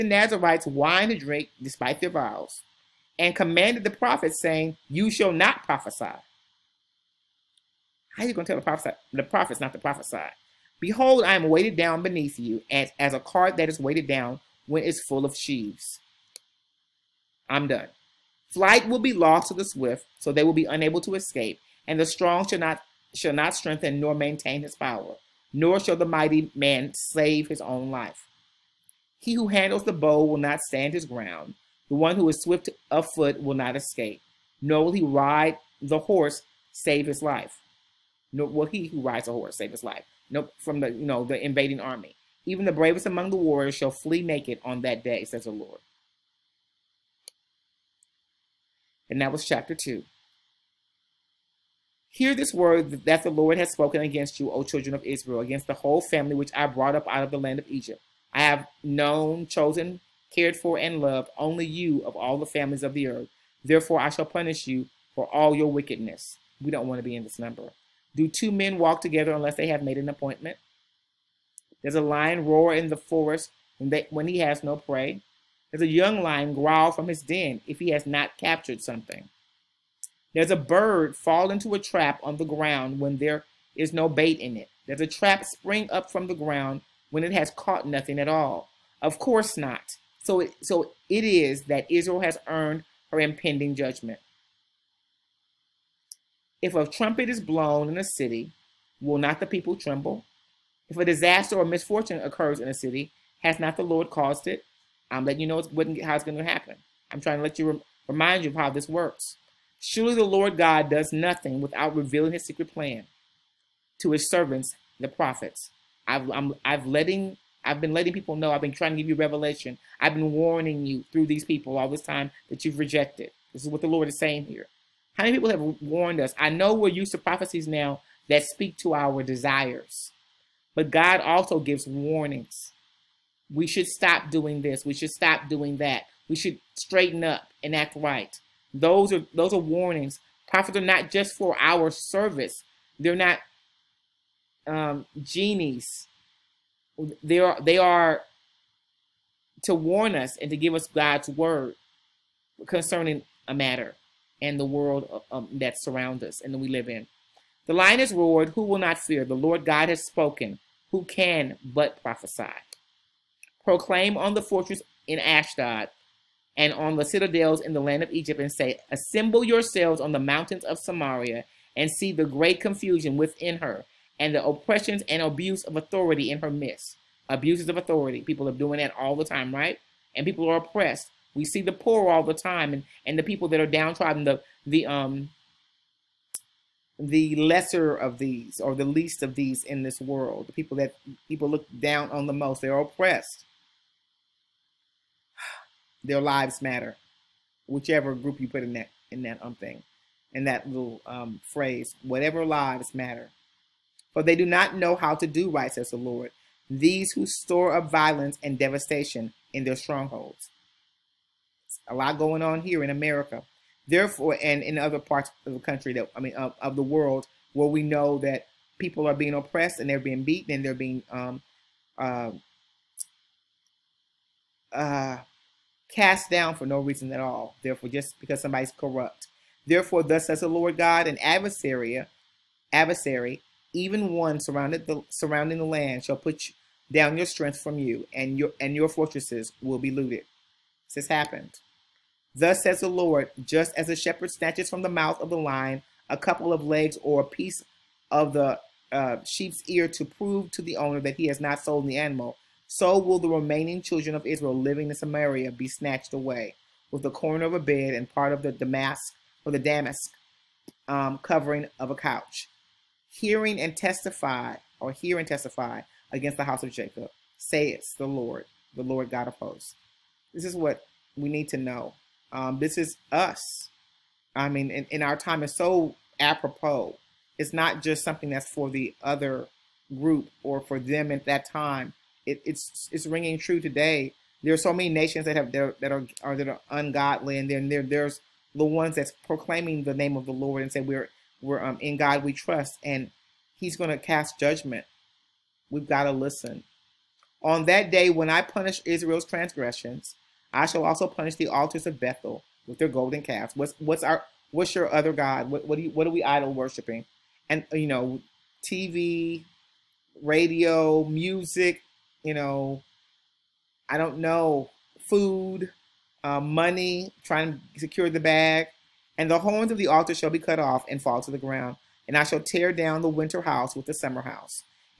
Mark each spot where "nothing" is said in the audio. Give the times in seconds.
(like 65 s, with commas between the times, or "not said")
87 s, 111 s.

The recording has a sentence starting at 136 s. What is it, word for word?
We should straighten up and act right.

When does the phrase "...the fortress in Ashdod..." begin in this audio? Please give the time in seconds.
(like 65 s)
164 s.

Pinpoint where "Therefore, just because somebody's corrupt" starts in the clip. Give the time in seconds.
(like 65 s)
227 s.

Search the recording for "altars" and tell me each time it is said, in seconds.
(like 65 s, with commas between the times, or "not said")
301 s, 319 s.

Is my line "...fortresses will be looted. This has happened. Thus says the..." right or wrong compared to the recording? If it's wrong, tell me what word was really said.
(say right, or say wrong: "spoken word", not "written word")
right.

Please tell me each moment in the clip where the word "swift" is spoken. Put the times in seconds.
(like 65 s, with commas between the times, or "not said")
19 s, 32 s.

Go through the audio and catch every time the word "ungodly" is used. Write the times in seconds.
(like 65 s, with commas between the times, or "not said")
286 s.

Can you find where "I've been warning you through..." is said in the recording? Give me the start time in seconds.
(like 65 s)
119 s.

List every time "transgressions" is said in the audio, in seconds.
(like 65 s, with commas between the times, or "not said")
299 s.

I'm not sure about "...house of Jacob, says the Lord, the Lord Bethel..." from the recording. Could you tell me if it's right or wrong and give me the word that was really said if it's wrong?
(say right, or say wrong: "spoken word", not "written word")
wrong: "God", not "Bethel".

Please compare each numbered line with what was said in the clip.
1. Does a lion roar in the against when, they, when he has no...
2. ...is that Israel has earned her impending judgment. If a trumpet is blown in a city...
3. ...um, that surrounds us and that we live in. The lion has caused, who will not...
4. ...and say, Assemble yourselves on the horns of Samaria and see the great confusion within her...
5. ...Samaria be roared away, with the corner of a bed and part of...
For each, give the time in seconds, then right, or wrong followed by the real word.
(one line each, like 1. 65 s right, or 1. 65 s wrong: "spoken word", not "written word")
1. 71 s wrong: "forest", not "against"
2. 91 s right
3. 155 s wrong: "roared", not "caused"
4. 168 s wrong: "mountains", not "horns"
5. 254 s wrong: "snatched", not "roared".